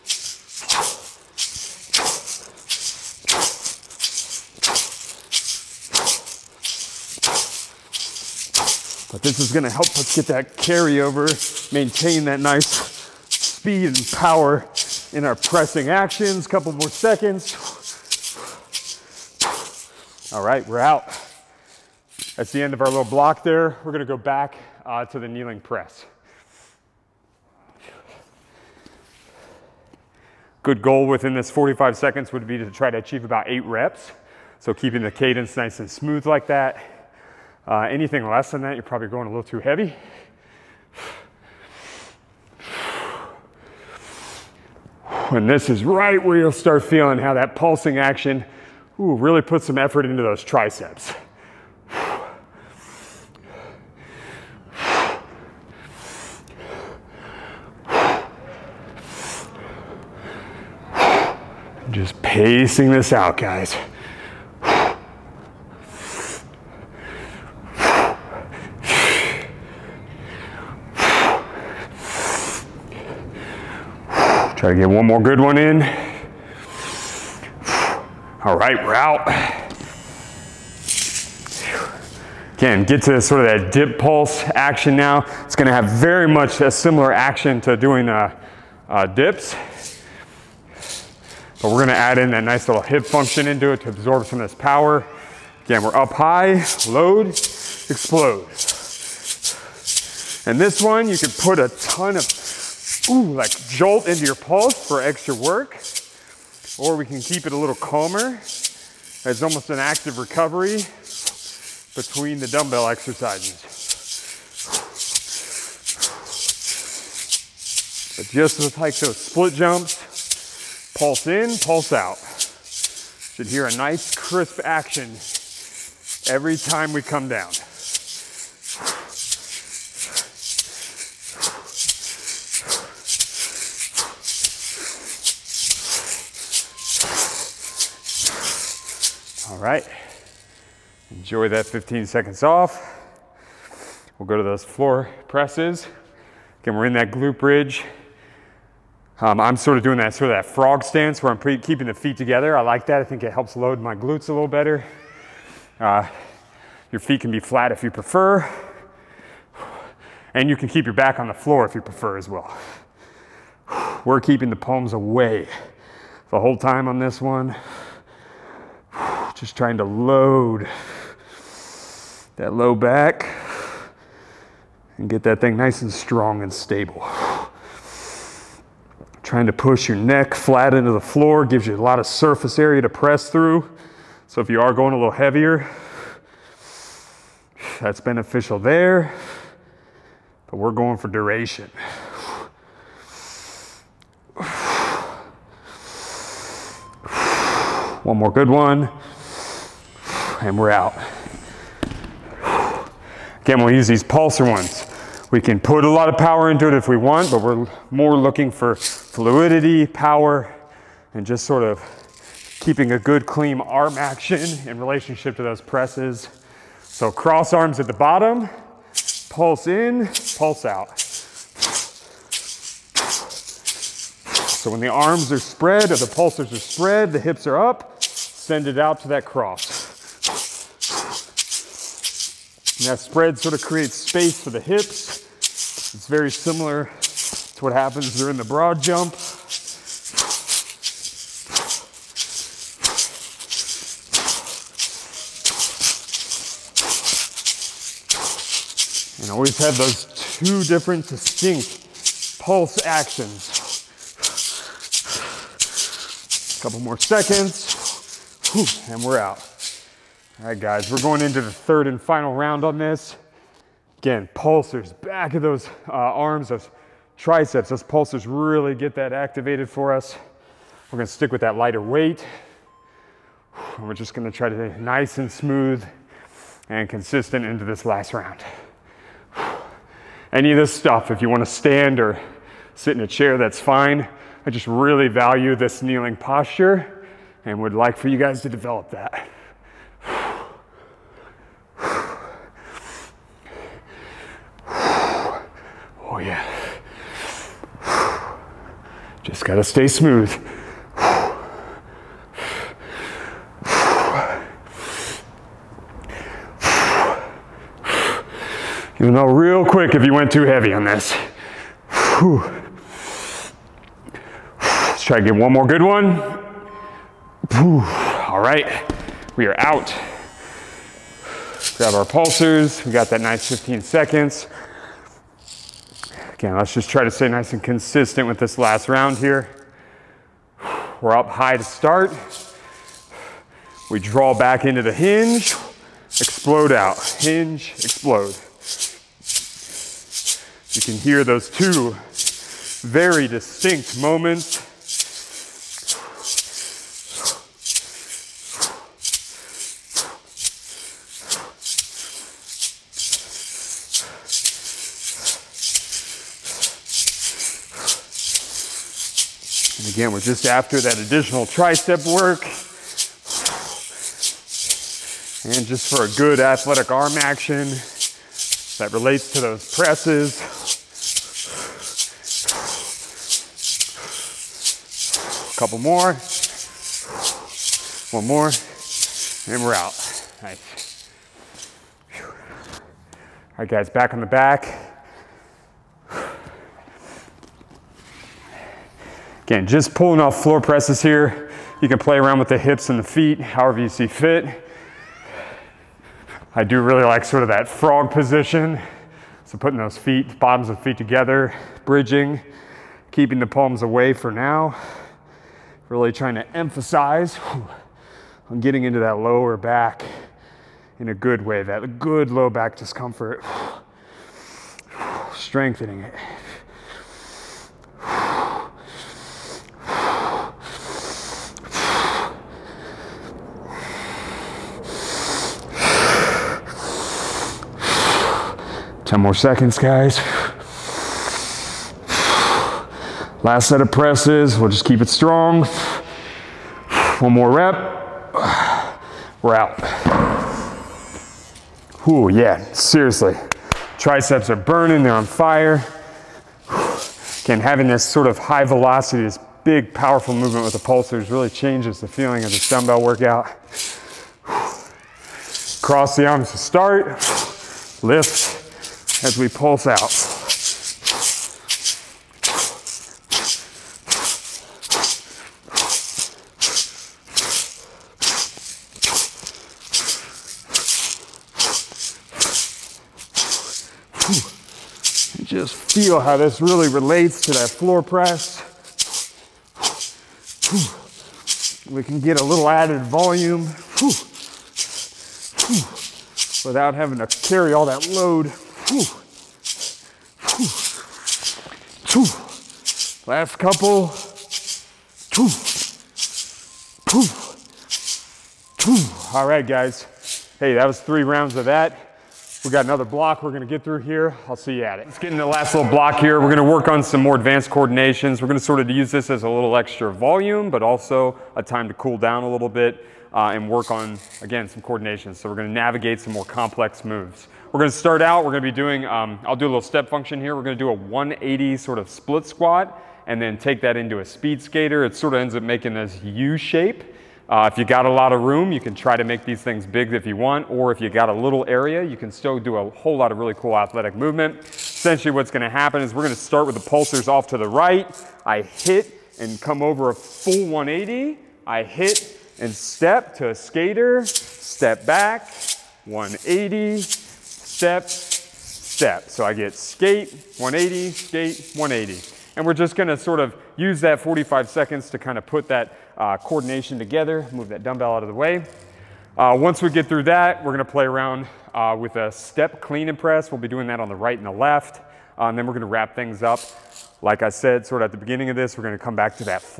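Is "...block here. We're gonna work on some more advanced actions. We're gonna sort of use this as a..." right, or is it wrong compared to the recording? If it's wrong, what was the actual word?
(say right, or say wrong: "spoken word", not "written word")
wrong: "coordinations", not "actions".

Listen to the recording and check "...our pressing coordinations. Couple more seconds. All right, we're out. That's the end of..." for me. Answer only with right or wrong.
wrong.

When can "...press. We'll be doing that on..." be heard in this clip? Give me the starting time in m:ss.
9:23.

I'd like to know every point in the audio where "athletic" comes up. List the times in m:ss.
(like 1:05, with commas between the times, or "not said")
6:06, 8:53.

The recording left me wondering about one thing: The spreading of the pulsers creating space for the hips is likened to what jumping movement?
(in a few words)
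Broad jump.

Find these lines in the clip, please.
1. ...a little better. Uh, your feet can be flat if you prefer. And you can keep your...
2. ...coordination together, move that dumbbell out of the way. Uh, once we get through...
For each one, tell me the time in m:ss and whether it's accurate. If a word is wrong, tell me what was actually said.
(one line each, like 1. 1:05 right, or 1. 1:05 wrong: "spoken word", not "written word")
1. 2:34 right
2. 9:16 right.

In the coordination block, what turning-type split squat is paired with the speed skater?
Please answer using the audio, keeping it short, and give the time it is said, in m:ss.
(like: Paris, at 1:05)
180, at 8:40.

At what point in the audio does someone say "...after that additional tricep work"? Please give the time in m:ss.
6:00.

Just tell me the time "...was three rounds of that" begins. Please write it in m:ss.
8:20.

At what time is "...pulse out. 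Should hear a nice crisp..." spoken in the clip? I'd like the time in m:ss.
2:01.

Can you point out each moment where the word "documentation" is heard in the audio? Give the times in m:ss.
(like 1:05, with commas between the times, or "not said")
not said.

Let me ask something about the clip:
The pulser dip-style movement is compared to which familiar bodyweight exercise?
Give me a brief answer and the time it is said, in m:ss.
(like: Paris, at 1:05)
Dips, at 1:29.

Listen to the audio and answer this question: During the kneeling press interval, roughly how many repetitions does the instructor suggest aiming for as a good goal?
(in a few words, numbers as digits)
8.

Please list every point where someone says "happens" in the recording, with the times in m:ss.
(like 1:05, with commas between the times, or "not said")
3:57, 8:55.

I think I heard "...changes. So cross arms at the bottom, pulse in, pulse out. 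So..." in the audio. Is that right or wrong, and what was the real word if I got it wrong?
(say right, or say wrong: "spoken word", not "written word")
wrong: "presses", not "changes".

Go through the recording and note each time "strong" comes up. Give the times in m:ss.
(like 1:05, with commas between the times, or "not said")
2:55, 7:15.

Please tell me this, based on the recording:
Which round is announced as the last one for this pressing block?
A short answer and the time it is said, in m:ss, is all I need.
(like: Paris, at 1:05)
Third, at 4:21.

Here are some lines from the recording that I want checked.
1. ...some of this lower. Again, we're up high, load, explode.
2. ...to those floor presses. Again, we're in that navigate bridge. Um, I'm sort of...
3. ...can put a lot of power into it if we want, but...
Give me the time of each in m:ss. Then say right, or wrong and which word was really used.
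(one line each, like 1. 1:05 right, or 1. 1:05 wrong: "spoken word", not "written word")
1. 1:34 wrong: "power", not "lower"
2. 2:24 wrong: "glute", not "navigate"
3. 3:25 right.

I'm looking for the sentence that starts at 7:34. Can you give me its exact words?
Cross the arms to start, lift, as we pulse out.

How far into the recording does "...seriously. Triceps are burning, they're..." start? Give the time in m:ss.
7:22.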